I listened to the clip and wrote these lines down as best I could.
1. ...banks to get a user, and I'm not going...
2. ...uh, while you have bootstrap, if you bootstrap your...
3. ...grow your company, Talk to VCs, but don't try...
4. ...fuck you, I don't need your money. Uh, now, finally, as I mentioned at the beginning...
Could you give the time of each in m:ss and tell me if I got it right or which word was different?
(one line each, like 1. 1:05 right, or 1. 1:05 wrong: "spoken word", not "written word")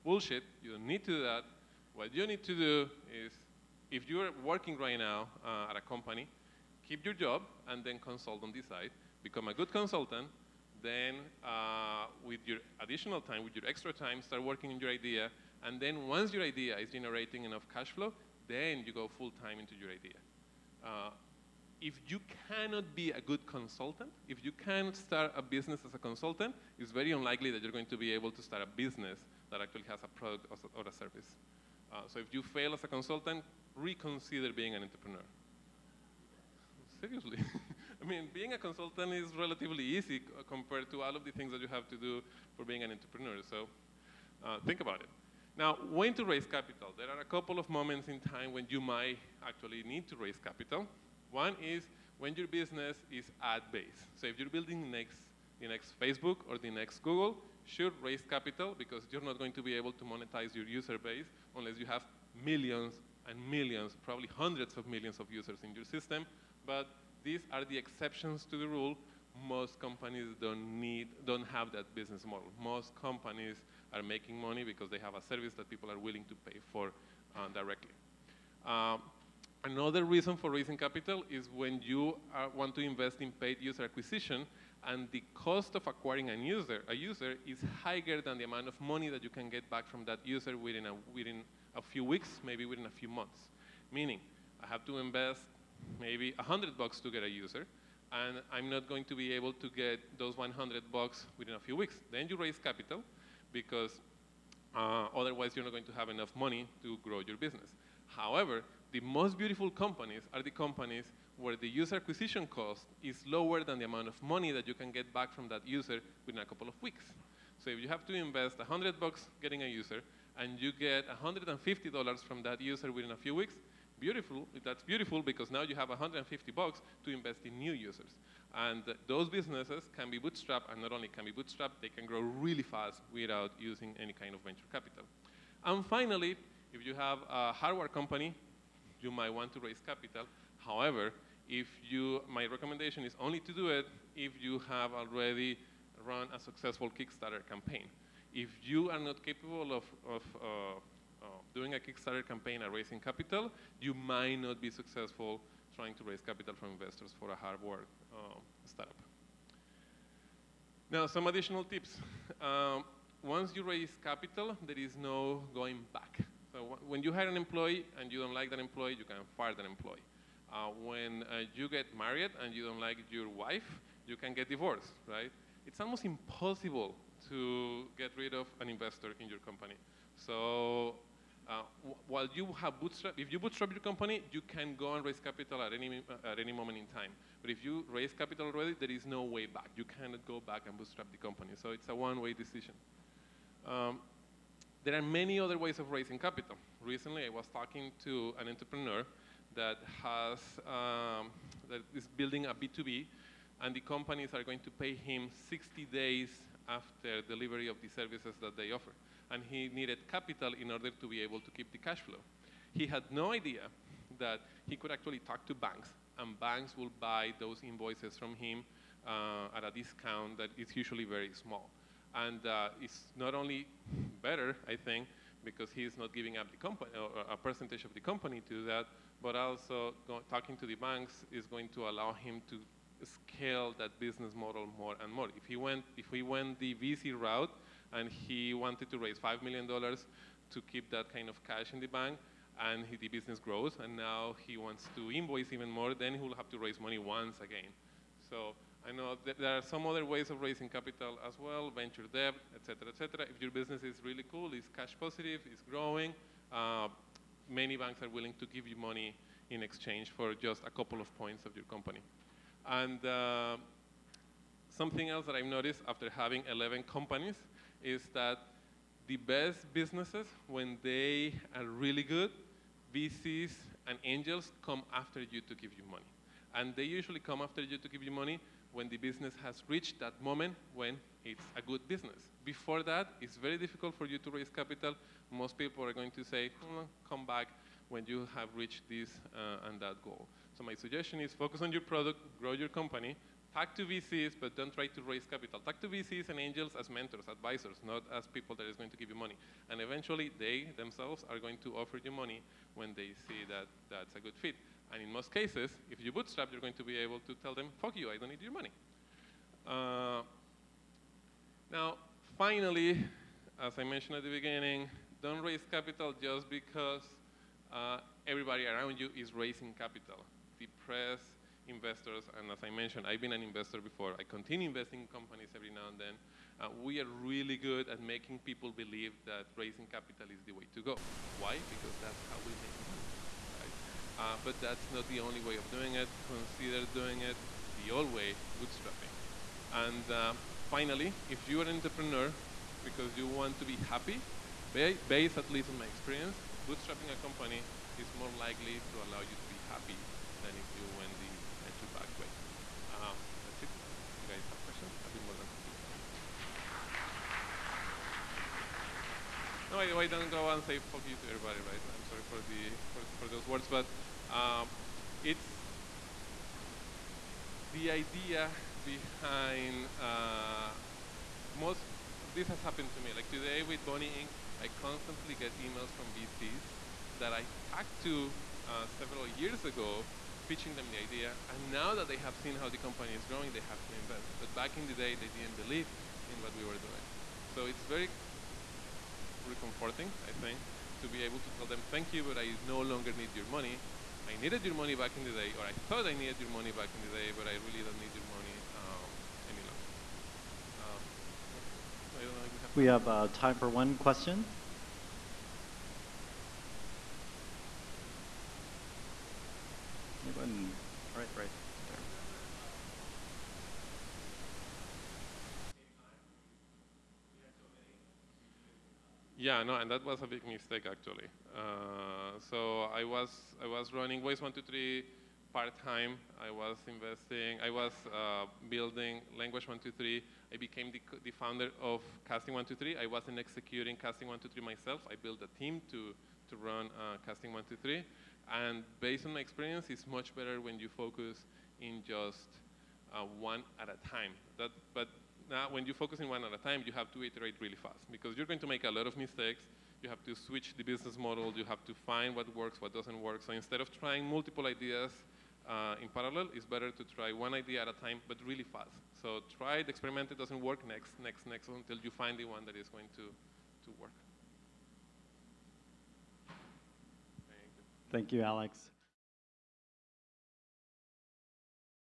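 1. 1:36 wrong: "bucks", not "banks"
2. 3:01 right
3. 4:52 right
4. 5:07 right.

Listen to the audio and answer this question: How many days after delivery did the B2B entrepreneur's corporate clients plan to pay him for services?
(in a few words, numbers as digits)
60 days.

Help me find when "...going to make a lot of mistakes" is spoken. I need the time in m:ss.
7:28.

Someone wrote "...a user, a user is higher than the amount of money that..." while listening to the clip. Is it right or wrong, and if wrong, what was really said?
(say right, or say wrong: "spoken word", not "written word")
right.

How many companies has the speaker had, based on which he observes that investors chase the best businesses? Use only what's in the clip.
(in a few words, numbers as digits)
11.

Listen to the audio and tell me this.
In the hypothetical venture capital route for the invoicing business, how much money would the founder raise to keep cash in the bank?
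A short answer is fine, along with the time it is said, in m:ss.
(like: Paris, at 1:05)
$5 million, at 3:59.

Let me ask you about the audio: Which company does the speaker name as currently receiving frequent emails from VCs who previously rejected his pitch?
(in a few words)
Bunny Inc.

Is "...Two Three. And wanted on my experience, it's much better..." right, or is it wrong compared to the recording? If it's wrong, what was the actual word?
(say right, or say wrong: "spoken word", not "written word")
wrong: "based", not "wanted".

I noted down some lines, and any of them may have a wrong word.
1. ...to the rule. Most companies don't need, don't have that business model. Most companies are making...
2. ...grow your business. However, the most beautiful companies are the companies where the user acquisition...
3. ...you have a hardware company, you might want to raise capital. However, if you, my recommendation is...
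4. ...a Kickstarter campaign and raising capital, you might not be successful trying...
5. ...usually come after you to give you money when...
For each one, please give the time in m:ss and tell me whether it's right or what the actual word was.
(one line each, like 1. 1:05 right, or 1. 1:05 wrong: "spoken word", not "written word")
1. 1:08 right
2. 1:47 right
3. 2:16 right
4. 2:31 right
5. 4:36 right.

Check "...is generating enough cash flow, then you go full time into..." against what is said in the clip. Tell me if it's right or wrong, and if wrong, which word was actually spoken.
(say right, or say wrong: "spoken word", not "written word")
right.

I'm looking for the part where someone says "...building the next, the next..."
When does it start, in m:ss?
0:54.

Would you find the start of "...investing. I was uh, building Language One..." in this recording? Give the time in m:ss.
7:06.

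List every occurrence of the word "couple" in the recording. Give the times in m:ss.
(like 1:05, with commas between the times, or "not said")
0:47, 1:56, 4:20.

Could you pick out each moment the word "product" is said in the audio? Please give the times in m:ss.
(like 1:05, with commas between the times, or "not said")
0:30, 4:51.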